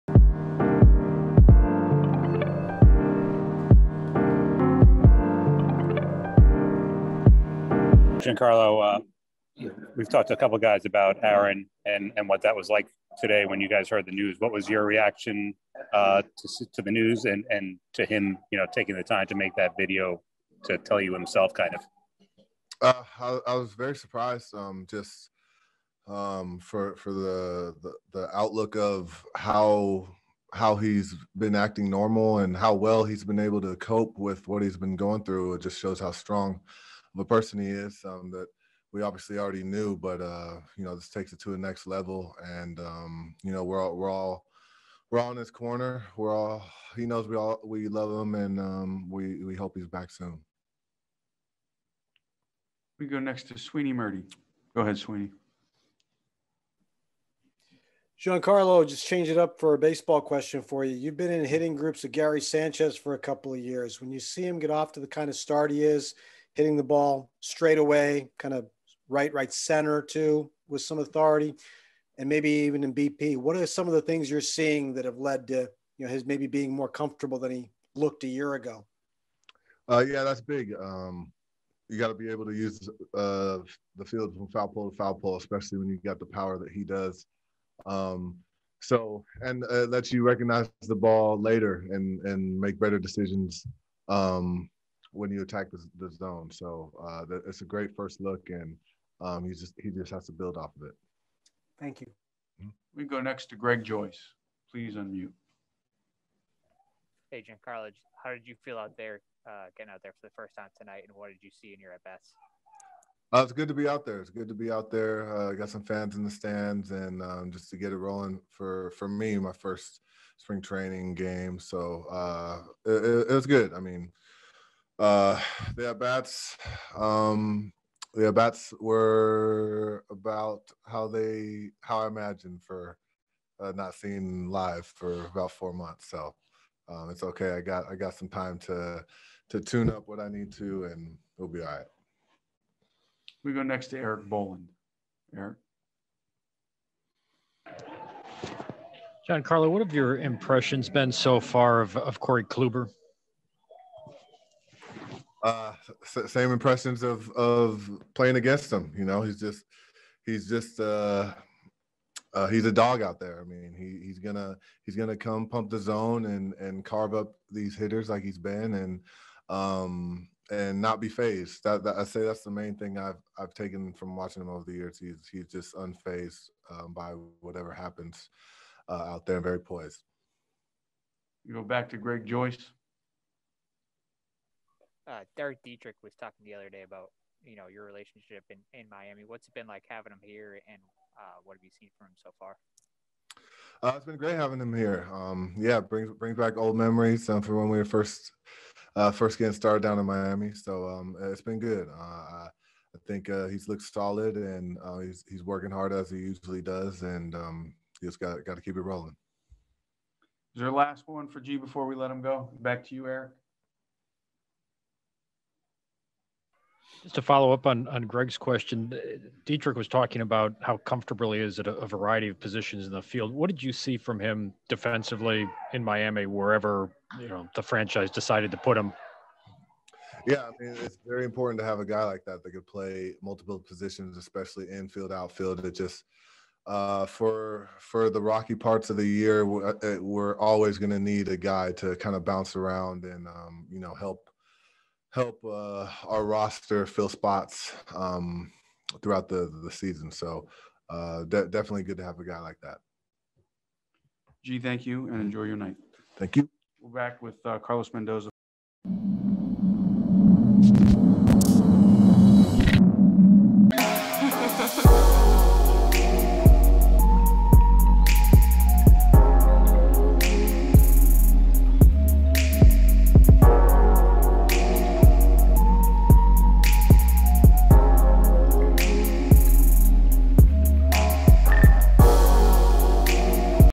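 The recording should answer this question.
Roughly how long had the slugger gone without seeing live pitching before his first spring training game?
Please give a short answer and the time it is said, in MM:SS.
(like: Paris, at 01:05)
4 months, at 02:15.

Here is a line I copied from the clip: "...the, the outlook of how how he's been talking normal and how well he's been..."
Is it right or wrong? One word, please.
wrong.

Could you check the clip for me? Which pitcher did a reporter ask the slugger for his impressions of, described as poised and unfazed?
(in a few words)
Corey Kluber.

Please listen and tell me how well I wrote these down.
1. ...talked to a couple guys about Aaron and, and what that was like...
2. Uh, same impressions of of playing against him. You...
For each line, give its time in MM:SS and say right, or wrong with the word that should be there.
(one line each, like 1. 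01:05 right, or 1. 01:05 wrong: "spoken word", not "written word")
1. 00:10 right
2. 02:35 right.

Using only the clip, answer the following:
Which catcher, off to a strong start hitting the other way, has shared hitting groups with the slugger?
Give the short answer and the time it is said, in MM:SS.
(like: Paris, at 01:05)
Gary Sanchez, at 01:02.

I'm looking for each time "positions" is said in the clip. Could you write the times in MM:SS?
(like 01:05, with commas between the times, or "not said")
03:42, 03:53.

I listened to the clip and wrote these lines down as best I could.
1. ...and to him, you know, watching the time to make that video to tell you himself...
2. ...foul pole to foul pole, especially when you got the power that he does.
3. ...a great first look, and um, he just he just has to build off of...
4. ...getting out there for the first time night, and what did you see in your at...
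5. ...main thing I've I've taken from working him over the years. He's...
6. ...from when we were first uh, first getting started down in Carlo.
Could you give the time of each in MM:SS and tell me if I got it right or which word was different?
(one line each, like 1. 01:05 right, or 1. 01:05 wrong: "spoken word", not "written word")
1. 00:17 wrong: "taking", not "watching"
2. 01:24 right
3. 01:37 right
4. 01:49 wrong: "tonight", not "night"
5. 02:52 wrong: "watching", not "working"
6. 03:17 wrong: "Miami", not "Carlo".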